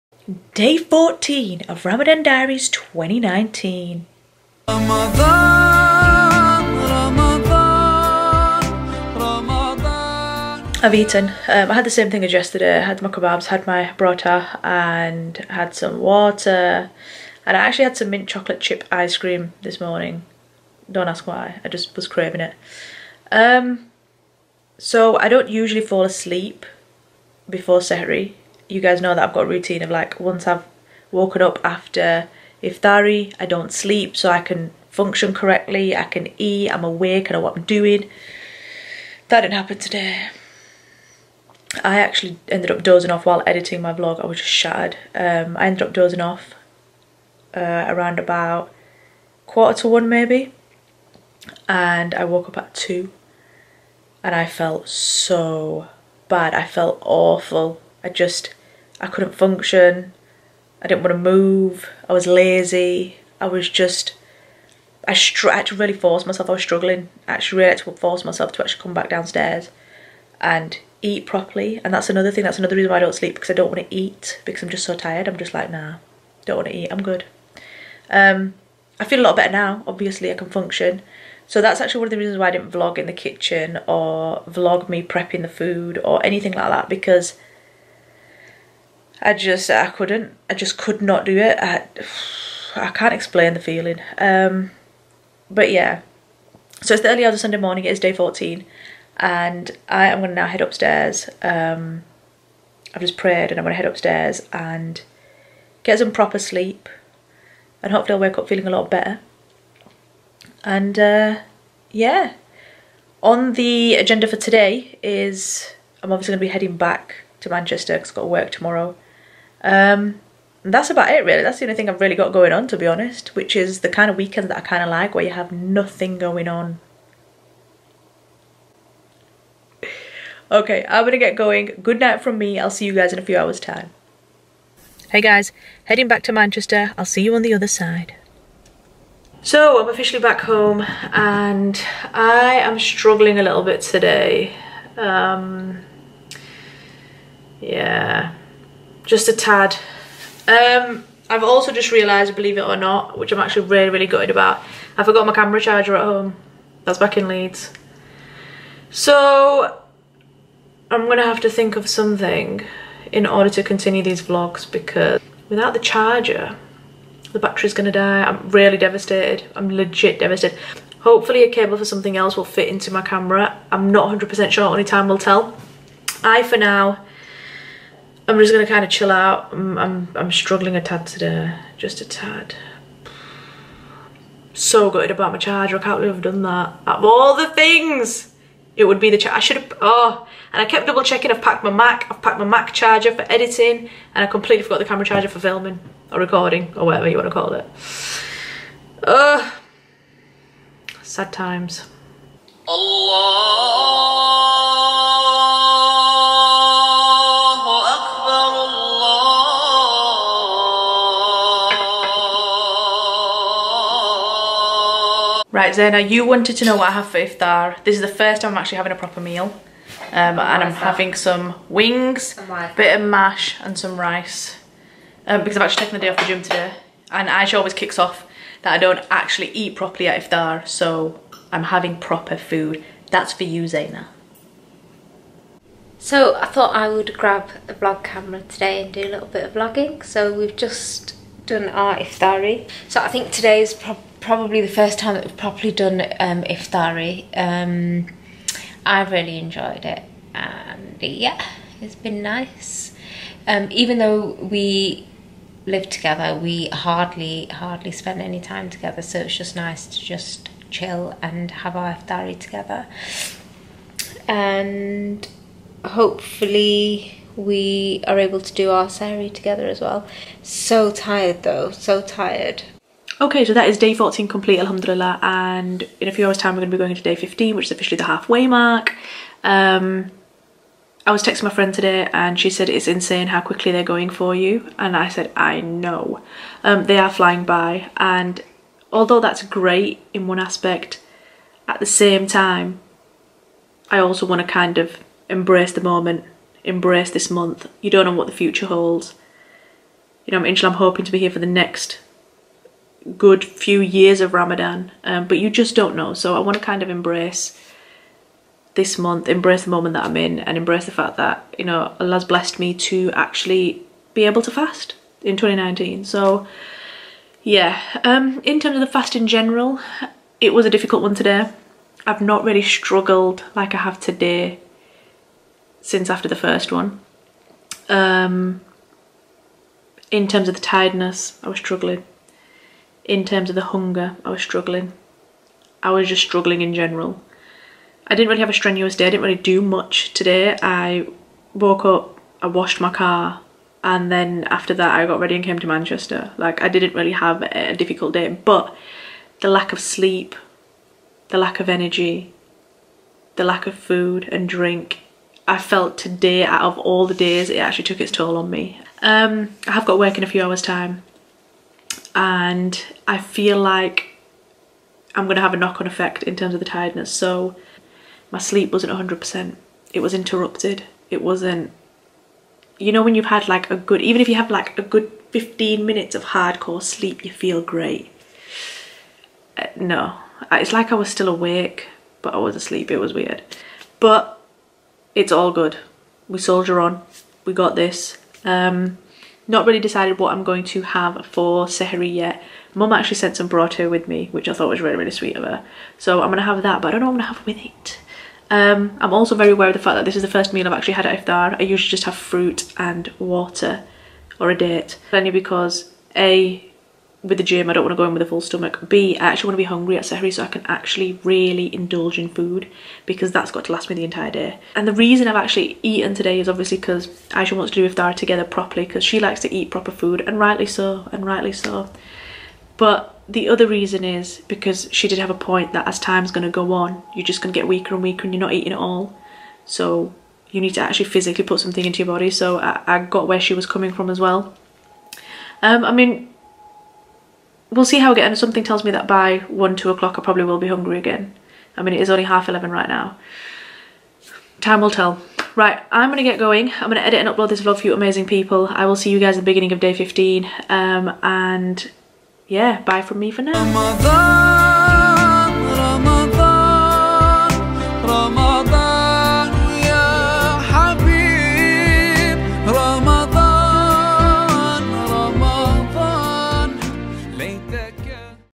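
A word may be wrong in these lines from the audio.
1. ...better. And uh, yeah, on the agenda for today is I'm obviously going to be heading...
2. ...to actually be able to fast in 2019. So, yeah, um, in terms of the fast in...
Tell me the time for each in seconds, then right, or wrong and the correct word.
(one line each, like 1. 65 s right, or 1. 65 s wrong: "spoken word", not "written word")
1. 108 s right
2. 312 s right.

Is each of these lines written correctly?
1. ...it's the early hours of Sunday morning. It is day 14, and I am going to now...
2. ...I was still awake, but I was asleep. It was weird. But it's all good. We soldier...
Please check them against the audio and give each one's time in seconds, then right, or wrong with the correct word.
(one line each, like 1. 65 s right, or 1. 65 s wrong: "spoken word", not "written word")
1. 96 s right
2. 380 s right.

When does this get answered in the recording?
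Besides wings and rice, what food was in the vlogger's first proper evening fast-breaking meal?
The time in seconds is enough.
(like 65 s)
223 s.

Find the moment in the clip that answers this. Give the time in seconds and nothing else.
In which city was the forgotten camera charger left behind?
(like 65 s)
157 s.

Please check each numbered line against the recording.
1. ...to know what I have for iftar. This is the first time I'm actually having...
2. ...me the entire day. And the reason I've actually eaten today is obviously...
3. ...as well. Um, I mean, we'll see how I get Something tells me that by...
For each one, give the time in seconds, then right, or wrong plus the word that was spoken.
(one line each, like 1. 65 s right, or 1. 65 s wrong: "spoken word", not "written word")
1. 216 s right
2. 413 s right
3. 434 s right.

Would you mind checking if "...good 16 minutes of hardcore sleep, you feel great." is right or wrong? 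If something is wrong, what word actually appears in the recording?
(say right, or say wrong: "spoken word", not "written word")
wrong: "15", not "16".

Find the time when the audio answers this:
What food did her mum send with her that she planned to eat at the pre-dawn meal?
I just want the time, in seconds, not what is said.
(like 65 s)
393 s.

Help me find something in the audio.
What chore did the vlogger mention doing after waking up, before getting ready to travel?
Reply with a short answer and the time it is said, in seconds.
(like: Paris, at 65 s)
washed my car, at 342 s.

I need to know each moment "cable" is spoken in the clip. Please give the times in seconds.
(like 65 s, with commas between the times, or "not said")
171 s.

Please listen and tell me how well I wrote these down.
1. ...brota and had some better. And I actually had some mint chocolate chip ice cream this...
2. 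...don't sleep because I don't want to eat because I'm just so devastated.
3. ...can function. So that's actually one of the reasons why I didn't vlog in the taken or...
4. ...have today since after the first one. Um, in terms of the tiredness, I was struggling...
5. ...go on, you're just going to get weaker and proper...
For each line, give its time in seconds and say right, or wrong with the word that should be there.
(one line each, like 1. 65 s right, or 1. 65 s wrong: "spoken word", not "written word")
1. 13 s wrong: "water", not "better"
2. 73 s wrong: "tired", not "devastated"
3. 80 s wrong: "kitchen", not "taken"
4. 323 s right
5. 426 s wrong: "weaker", not "proper".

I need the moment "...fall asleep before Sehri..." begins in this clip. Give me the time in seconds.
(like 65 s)
25 s.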